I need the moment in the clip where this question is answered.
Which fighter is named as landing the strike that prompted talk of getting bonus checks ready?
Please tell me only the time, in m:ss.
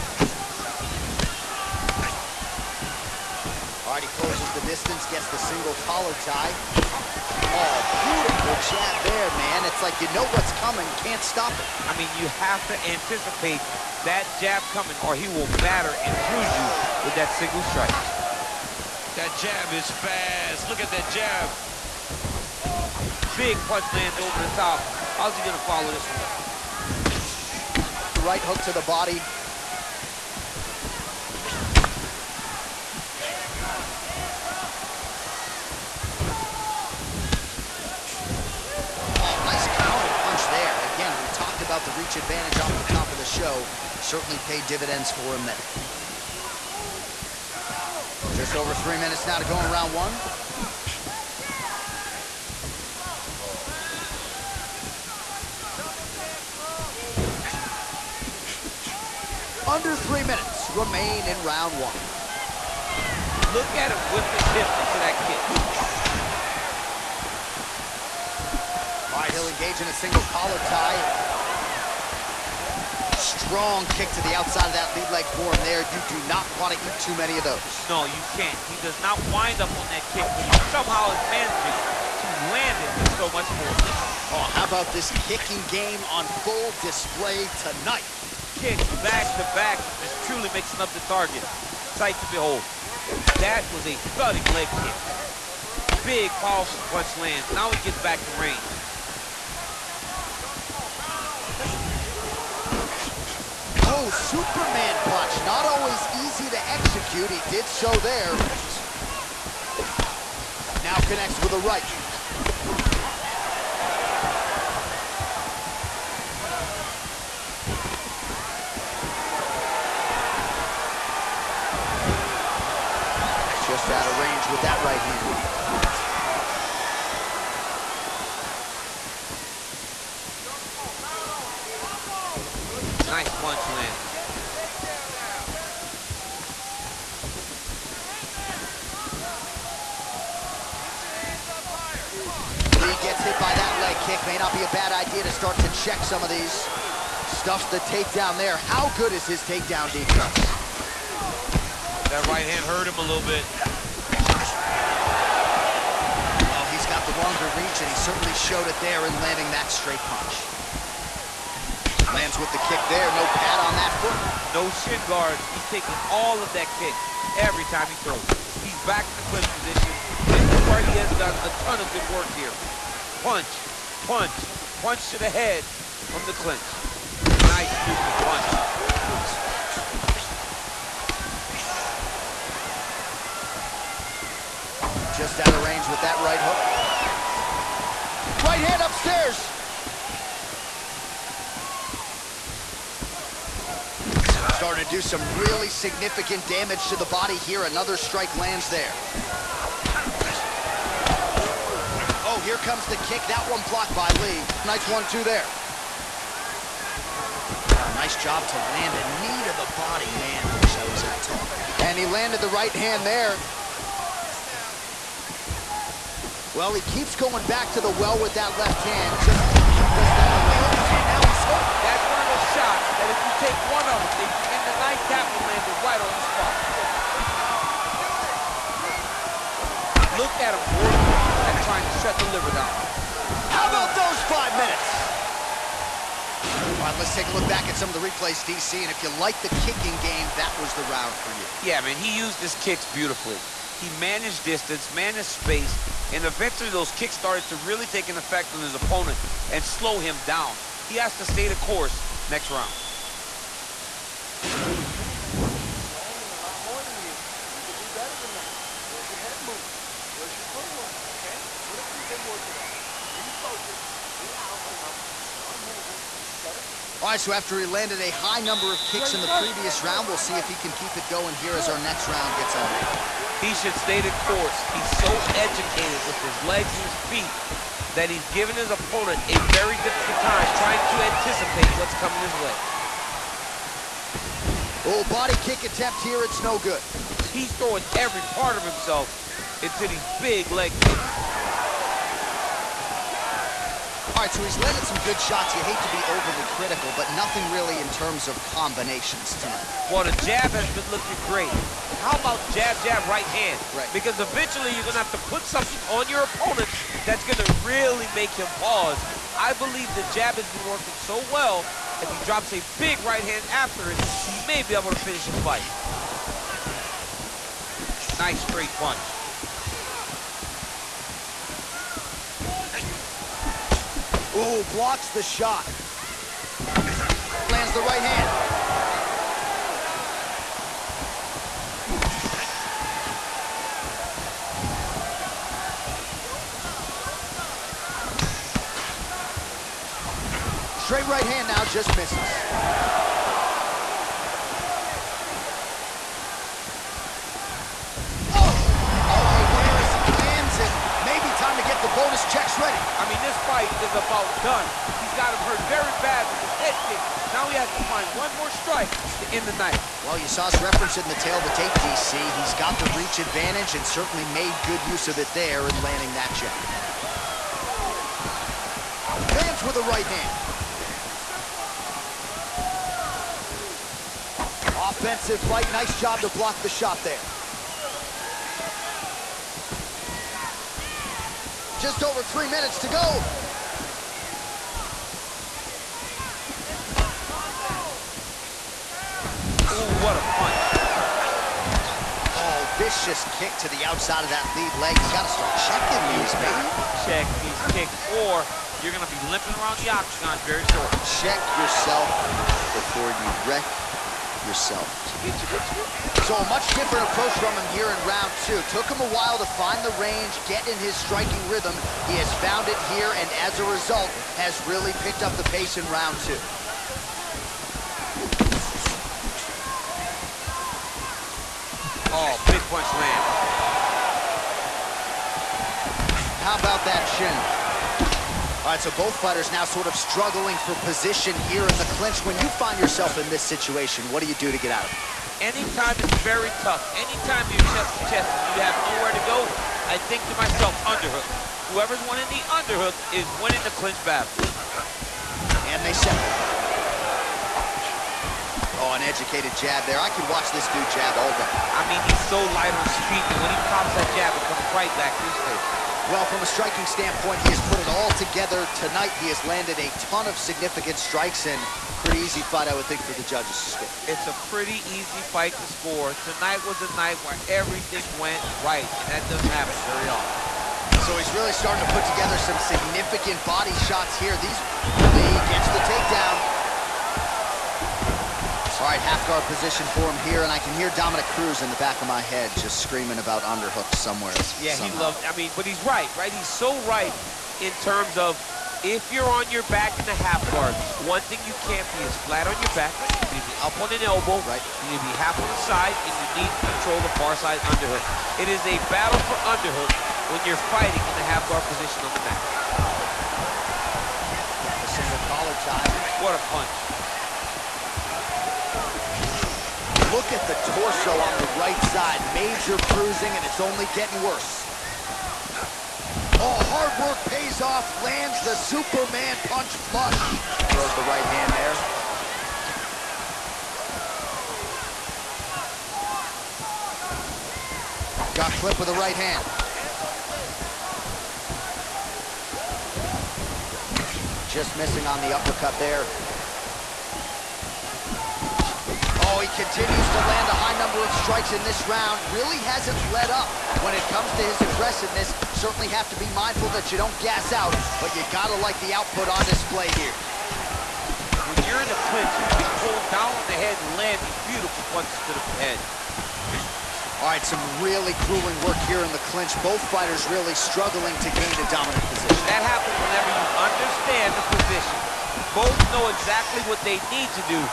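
5:48.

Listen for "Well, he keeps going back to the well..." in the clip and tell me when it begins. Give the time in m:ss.
3:36.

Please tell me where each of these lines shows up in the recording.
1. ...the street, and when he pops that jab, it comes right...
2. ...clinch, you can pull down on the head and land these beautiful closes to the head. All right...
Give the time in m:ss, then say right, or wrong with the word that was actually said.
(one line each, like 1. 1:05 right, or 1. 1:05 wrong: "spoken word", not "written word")
1. 7:32 right
2. 9:12 wrong: "punches", not "closes".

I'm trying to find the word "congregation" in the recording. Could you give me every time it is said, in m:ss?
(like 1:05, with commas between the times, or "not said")
not said.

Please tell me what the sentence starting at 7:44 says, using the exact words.
It's a pretty easy fight to score.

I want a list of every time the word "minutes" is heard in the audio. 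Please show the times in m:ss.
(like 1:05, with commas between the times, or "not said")
0:48, 1:00, 3:54, 6:22.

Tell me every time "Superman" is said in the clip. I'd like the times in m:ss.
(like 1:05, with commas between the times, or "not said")
1:44, 8:38.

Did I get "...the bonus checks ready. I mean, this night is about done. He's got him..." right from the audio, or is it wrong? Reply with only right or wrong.
wrong.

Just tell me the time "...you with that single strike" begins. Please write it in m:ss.
0:16.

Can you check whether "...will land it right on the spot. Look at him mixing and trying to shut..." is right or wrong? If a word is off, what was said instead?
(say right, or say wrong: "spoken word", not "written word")
wrong: "working", not "mixing".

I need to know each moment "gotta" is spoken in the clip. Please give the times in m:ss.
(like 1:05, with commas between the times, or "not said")
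6:35, 9:08.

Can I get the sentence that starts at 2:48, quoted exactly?
He's back in the clinch position.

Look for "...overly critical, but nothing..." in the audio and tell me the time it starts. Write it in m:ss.
4:56.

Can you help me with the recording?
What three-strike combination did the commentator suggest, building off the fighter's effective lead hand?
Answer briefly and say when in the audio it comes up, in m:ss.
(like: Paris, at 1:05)
jab, jab, right hand, at 5:02.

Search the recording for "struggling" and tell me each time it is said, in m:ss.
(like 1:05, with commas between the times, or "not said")
7:09, 9:20.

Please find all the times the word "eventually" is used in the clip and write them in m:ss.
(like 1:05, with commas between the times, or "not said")
4:06, 5:04.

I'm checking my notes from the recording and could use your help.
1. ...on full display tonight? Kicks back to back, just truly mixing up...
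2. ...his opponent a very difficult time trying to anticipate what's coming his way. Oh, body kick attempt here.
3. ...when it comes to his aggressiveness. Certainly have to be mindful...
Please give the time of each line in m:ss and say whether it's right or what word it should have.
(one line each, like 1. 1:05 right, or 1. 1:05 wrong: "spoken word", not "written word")
1. 1:26 right
2. 4:38 right
3. 9:03 right.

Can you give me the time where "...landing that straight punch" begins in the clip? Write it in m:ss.
2:39.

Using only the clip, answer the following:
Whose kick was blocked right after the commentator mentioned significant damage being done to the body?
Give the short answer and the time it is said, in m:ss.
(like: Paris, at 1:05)
Lee, at 3:24.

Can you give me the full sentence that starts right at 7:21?
Whoever's winning the underhook is winning the clinch battle.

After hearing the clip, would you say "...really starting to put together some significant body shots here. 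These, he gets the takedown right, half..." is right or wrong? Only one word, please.
right.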